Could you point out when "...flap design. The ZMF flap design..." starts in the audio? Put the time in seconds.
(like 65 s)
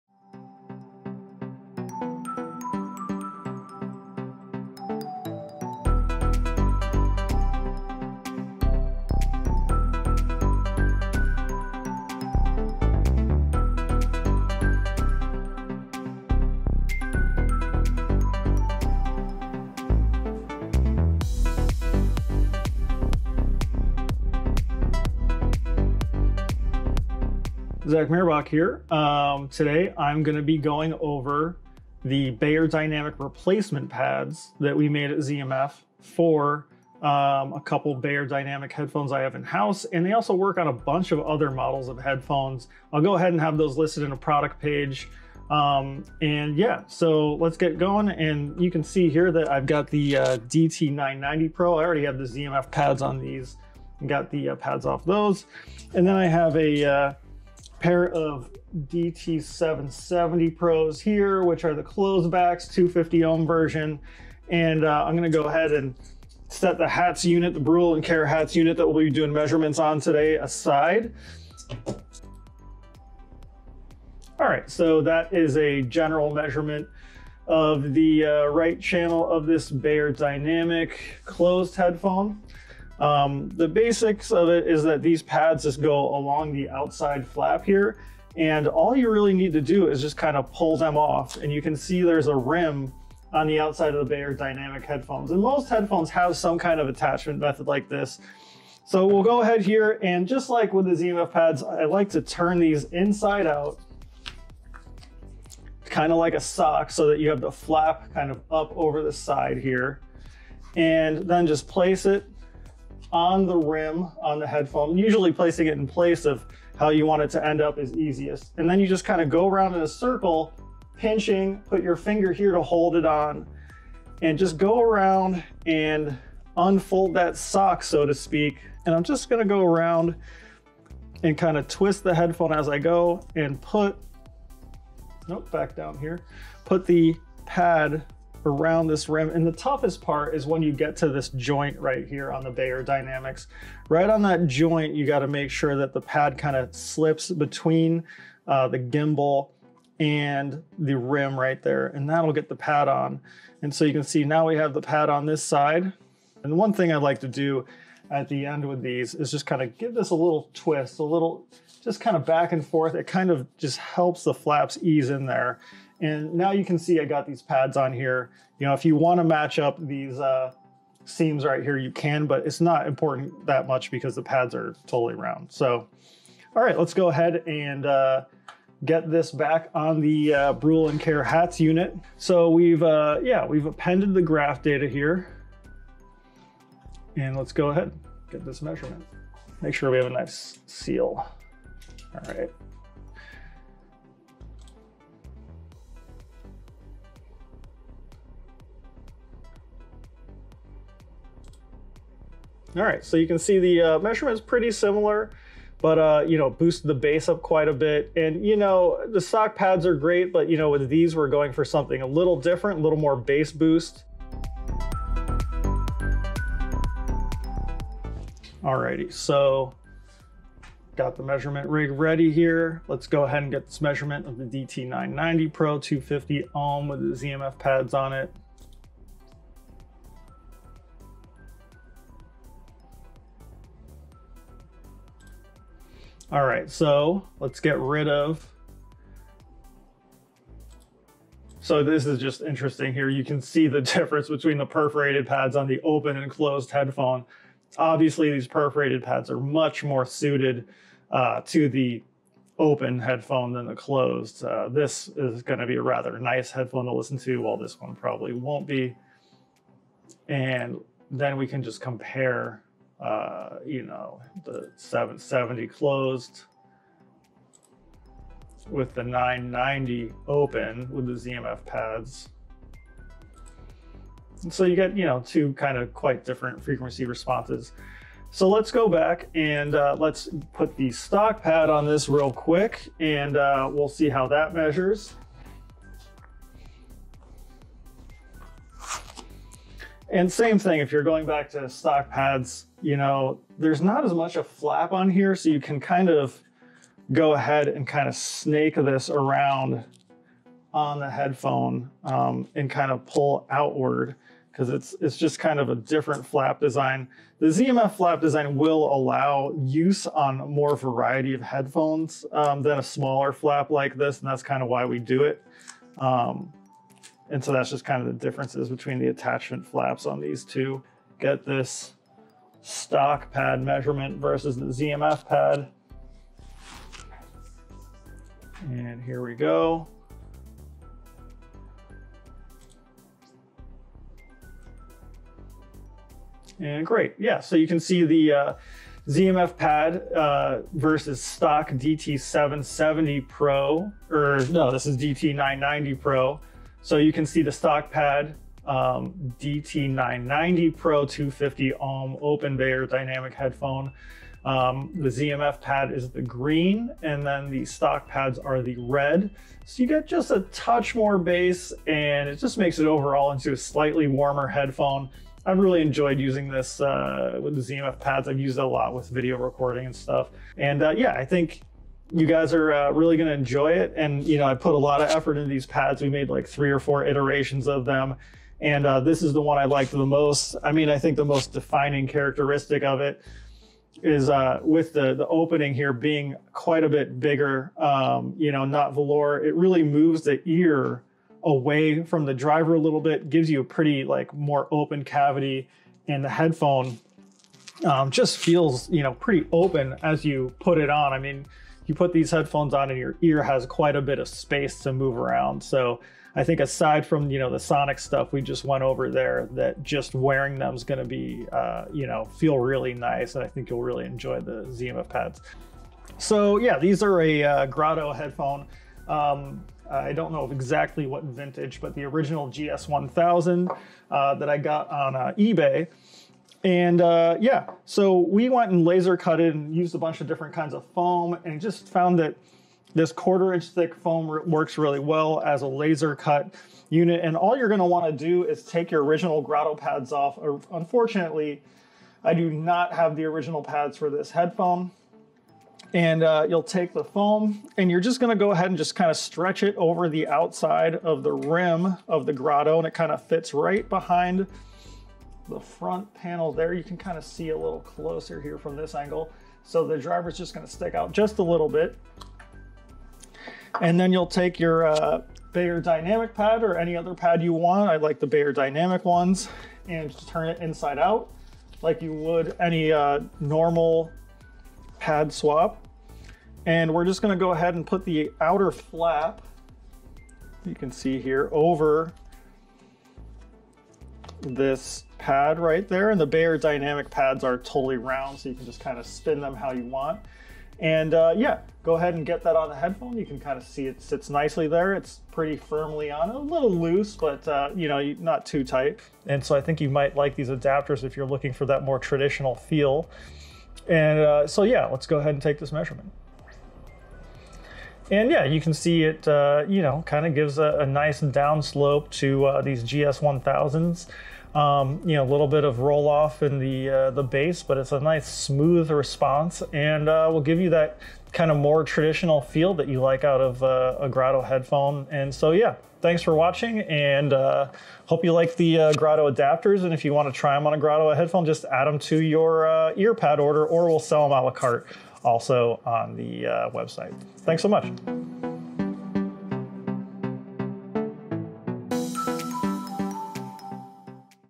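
306 s.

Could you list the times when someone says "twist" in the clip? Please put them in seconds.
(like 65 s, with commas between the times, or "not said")
131 s, 160 s.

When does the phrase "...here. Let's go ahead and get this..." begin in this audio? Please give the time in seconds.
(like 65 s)
222 s.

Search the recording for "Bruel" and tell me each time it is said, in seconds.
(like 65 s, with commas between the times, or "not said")
67 s, 180 s.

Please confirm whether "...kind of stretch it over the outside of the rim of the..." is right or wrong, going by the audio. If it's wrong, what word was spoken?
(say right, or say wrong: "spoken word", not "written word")
right.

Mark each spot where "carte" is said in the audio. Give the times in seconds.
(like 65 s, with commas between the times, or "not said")
534 s.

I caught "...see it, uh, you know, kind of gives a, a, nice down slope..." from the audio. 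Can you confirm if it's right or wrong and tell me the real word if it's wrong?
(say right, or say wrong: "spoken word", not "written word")
right.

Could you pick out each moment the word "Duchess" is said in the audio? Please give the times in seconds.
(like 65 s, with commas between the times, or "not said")
not said.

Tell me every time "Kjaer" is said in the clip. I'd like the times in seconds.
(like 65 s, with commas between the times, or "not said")
68 s, 180 s.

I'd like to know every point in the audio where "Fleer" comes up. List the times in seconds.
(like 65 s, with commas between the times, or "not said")
not said.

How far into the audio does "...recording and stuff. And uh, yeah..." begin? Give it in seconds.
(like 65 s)
369 s.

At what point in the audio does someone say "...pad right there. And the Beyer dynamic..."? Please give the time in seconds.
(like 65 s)
485 s.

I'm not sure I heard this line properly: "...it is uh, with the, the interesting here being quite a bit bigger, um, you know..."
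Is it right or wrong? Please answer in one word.
wrong.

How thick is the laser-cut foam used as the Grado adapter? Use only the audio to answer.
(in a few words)
Quarter inch.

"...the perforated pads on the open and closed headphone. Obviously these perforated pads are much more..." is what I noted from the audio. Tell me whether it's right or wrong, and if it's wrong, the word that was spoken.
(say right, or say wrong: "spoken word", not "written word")
right.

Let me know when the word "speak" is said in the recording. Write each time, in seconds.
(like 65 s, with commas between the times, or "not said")
128 s.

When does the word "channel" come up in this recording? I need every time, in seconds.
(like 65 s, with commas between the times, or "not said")
78 s.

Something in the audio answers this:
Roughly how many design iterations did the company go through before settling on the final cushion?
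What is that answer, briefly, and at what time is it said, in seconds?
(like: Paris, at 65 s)
3 or 4, at 376 s.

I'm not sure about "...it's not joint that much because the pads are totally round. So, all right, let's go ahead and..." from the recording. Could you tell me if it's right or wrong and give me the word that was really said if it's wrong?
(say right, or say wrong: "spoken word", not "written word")
wrong: "important", not "joint".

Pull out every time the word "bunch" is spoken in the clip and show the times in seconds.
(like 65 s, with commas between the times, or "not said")
40 s, 429 s.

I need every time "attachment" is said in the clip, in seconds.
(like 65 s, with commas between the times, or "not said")
96 s, 319 s.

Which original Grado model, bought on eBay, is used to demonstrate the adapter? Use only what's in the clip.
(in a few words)
GS1000.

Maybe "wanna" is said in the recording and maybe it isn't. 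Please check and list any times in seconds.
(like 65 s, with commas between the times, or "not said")
437 s.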